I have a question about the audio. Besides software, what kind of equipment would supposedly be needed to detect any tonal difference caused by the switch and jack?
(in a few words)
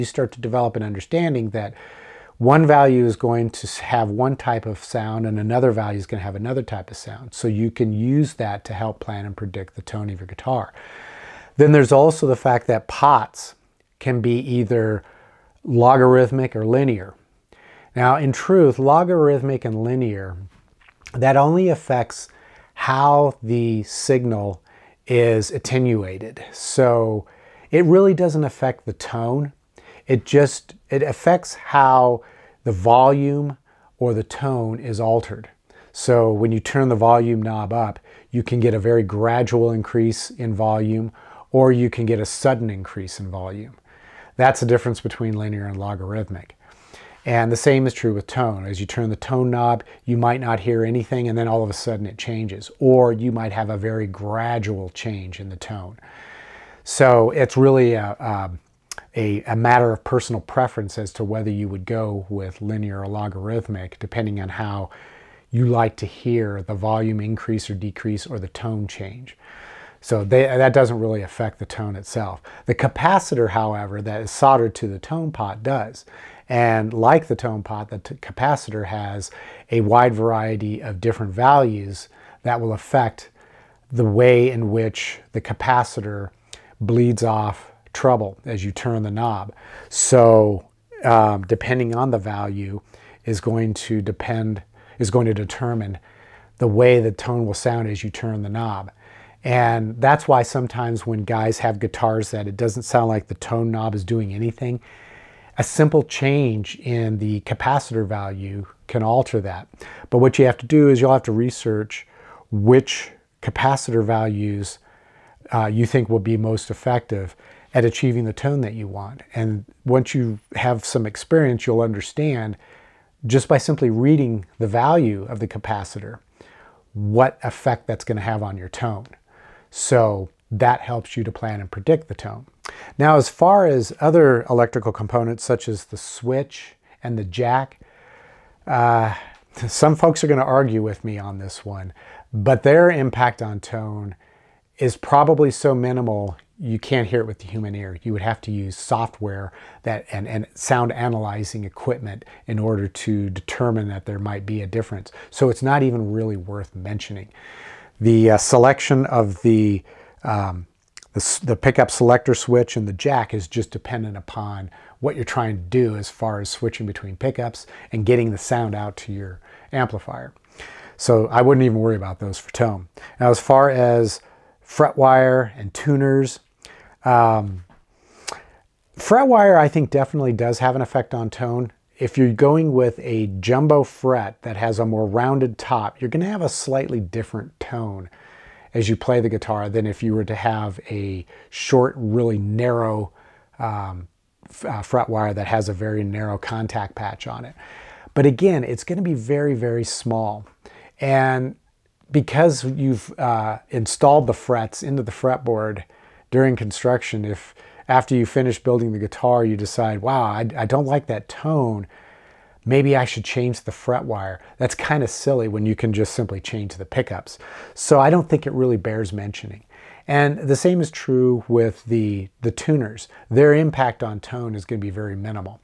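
Sound analyzing equipment.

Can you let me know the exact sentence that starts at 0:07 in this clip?
So you can use that to help plan and predict the tone of your guitar.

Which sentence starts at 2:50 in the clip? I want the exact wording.
So I wouldn't even worry about those for tone.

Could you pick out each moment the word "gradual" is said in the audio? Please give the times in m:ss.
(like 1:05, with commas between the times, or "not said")
0:39, 0:54.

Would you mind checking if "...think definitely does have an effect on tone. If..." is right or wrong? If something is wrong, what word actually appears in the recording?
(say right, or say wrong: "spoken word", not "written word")
right.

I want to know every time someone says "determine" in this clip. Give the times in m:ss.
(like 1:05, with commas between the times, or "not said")
1:35, 2:33.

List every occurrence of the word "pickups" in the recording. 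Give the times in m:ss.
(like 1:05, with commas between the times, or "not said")
2:41, 2:47, 3:36.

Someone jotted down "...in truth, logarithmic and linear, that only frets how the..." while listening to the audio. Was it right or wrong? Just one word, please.
wrong.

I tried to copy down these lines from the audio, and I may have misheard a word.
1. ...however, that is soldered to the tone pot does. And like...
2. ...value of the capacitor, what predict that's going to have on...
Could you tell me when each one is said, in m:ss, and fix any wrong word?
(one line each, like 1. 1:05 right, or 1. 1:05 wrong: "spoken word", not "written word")
1. 1:13 right
2. 2:04 wrong: "effect", not "predict".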